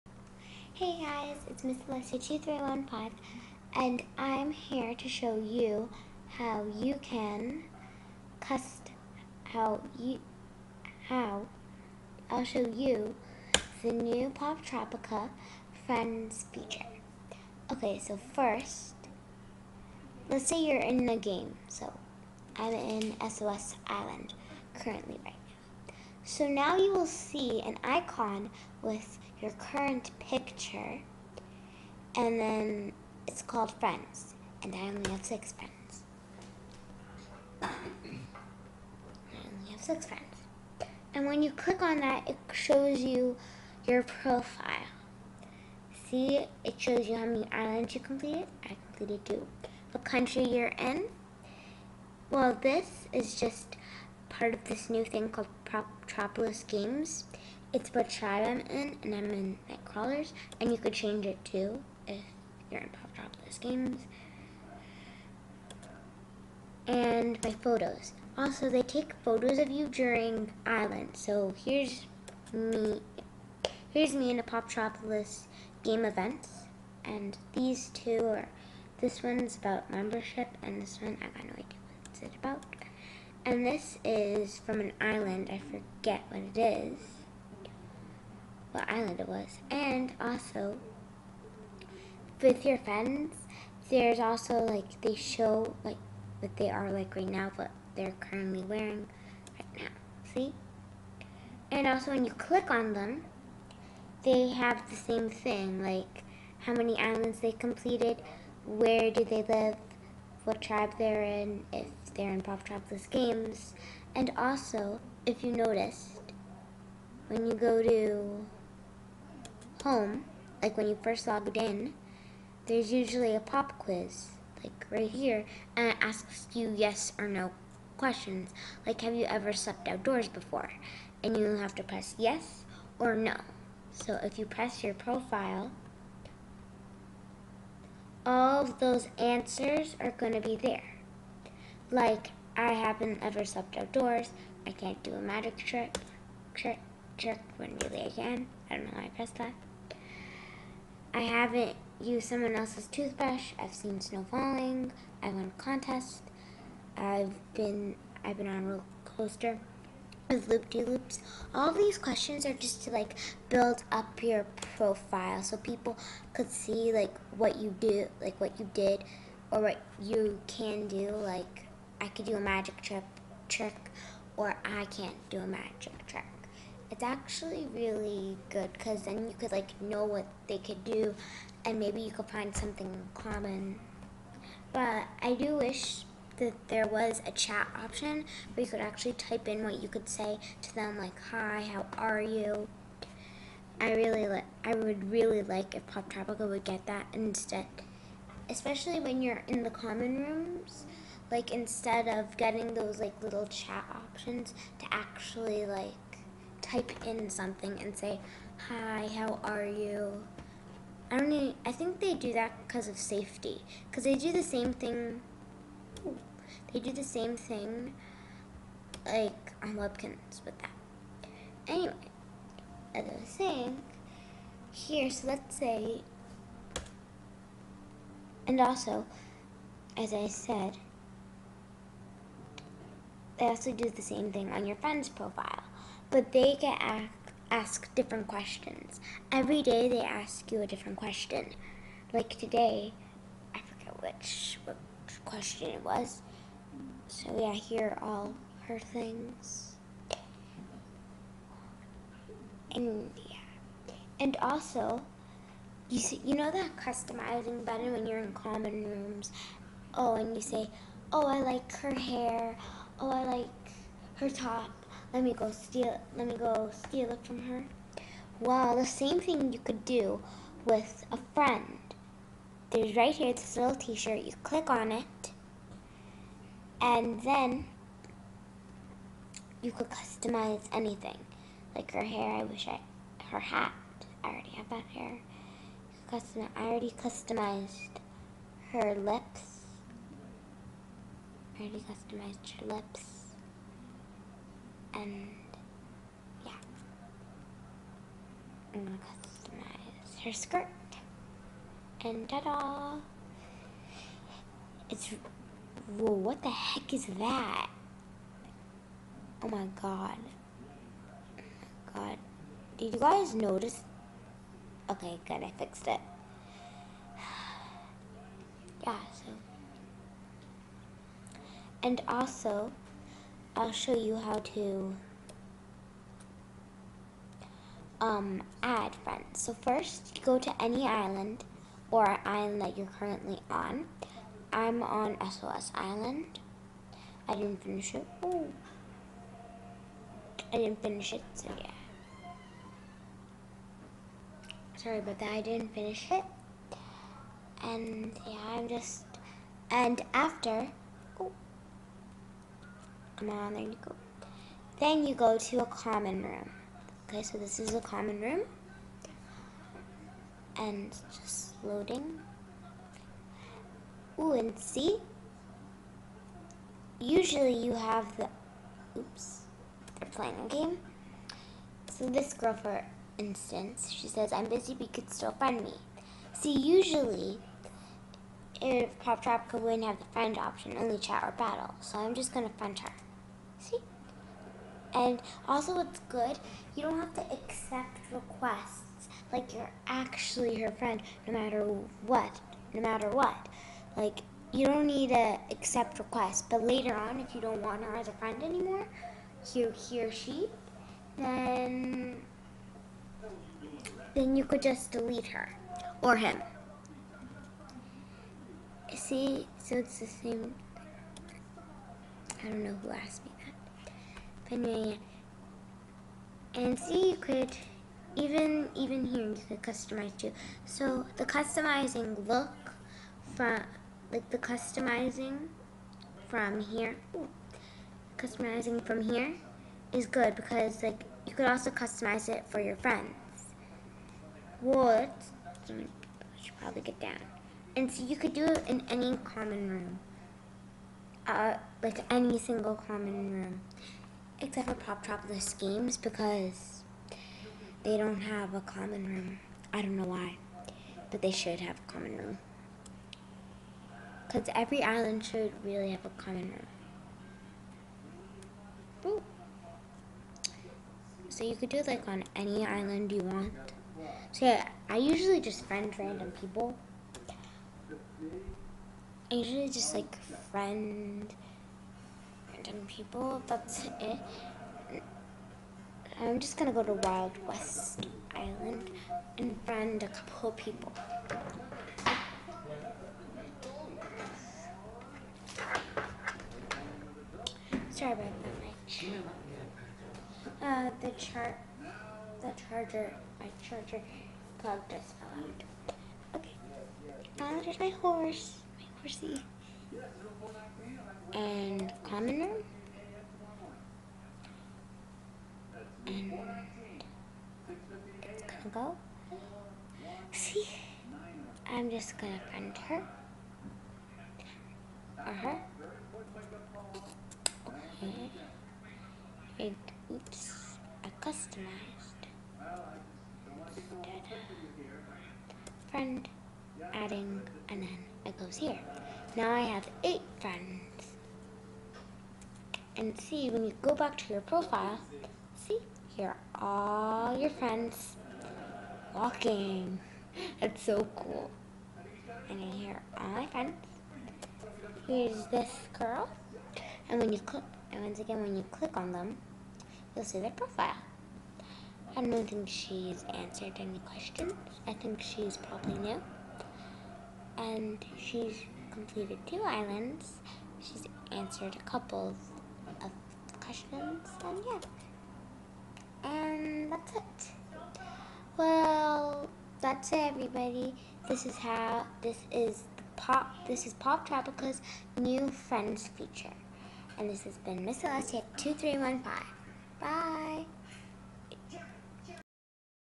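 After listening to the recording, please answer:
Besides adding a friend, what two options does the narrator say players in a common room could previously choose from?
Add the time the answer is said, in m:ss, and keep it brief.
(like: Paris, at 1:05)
Chat or battle, at 6:20.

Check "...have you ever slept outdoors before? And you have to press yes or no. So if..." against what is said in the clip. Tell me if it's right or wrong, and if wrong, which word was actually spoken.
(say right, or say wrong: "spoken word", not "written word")
right.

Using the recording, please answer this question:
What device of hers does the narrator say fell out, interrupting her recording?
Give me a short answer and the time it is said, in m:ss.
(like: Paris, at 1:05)
Charger plug, at 8:13.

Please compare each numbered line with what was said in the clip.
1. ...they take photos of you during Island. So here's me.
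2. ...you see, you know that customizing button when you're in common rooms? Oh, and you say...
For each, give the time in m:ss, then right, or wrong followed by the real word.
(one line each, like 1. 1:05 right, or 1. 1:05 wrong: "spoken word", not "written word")
1. 1:08 right
2. 4:15 right.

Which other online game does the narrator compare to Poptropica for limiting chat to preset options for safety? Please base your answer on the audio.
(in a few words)
Webkinz.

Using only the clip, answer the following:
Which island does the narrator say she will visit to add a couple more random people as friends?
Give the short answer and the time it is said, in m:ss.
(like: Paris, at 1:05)
Wild West Island, at 7:57.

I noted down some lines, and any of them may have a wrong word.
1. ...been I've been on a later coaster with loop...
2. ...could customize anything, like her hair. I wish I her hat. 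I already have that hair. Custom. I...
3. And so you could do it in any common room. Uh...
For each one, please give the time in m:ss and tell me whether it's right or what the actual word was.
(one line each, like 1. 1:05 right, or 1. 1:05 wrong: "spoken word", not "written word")
1. 2:37 wrong: "roller", not "later"
2. 4:39 right
3. 7:17 right.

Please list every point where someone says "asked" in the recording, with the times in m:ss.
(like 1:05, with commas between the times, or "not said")
3:56, 6:52.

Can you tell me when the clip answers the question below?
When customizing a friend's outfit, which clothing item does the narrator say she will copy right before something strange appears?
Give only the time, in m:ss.
5:00.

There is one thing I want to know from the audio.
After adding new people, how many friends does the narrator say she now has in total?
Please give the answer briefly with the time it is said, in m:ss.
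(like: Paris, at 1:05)
8, at 8:50.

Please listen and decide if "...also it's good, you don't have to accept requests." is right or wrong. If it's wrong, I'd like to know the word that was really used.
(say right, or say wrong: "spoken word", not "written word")
right.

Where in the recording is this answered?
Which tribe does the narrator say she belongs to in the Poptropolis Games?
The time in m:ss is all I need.
0:59.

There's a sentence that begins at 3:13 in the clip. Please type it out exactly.
I really like I would really like if Poptropica would get that instead.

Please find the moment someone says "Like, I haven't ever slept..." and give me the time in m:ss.
2:21.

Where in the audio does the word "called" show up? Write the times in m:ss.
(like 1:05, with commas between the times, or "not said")
0:33, 0:55.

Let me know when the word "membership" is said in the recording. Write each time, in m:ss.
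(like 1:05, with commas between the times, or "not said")
1:19.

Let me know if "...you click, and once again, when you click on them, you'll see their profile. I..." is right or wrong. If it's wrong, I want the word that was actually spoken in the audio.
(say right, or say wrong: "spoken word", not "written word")
right.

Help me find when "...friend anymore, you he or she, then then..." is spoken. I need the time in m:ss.
6:38.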